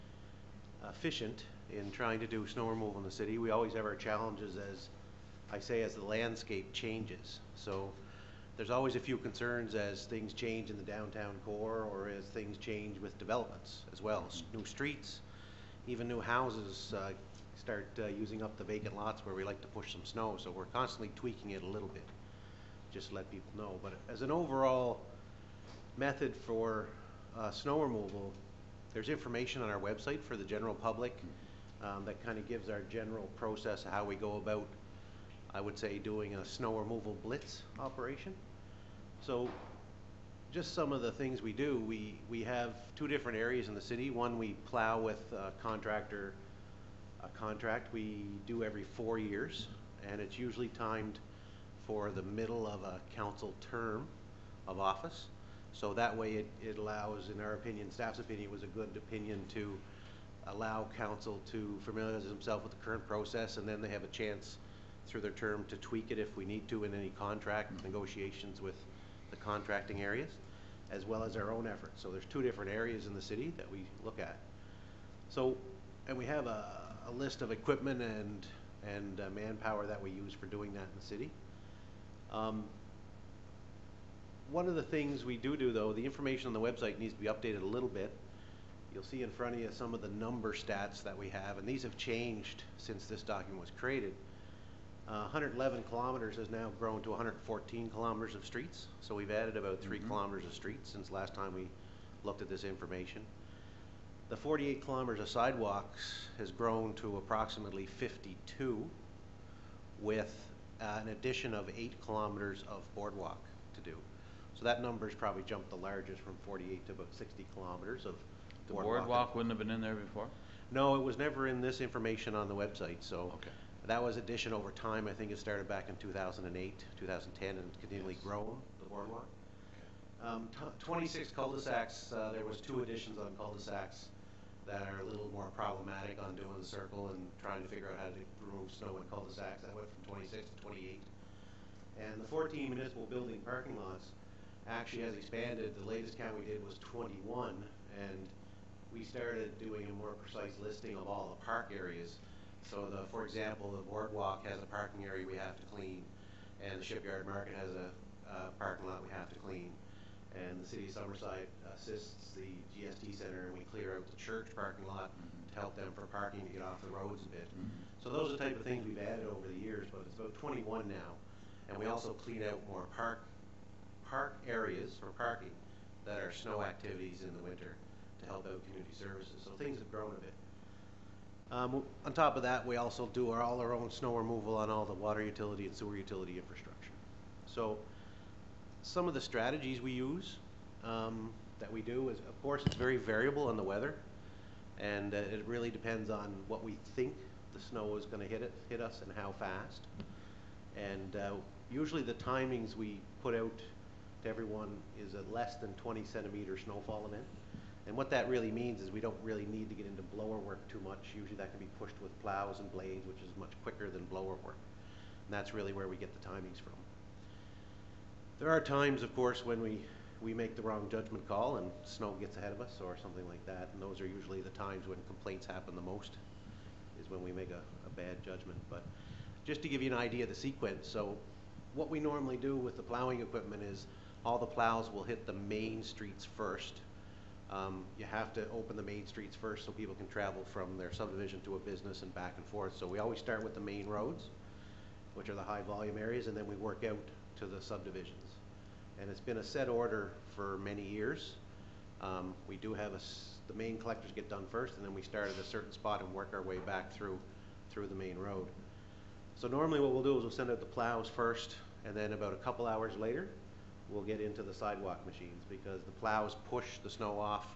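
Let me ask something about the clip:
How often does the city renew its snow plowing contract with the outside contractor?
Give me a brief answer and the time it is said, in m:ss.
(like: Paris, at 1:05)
every 4 years, at 0:48.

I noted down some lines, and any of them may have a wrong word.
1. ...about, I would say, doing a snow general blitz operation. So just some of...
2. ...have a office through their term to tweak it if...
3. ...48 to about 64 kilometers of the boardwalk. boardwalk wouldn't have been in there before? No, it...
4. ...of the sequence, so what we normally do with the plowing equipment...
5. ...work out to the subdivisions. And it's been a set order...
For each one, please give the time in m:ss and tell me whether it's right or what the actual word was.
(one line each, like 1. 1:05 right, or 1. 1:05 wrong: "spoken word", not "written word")
1. 0:34 wrong: "removal", not "general"
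2. 1:03 wrong: "chance", not "office"
3. 1:56 wrong: "60", not "64"
4. 3:50 right
5. 4:06 right.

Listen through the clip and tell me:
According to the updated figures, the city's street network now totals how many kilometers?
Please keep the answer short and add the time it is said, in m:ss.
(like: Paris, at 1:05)
114 kilometers, at 1:37.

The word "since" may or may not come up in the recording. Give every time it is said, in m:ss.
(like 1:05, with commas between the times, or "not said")
1:32, 1:40.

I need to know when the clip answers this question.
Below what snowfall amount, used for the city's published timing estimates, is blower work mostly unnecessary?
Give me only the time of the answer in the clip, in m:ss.
3:25.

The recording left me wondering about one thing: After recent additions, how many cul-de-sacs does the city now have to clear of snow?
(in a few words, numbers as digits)
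28.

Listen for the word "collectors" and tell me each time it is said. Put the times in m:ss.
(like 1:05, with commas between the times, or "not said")
4:13.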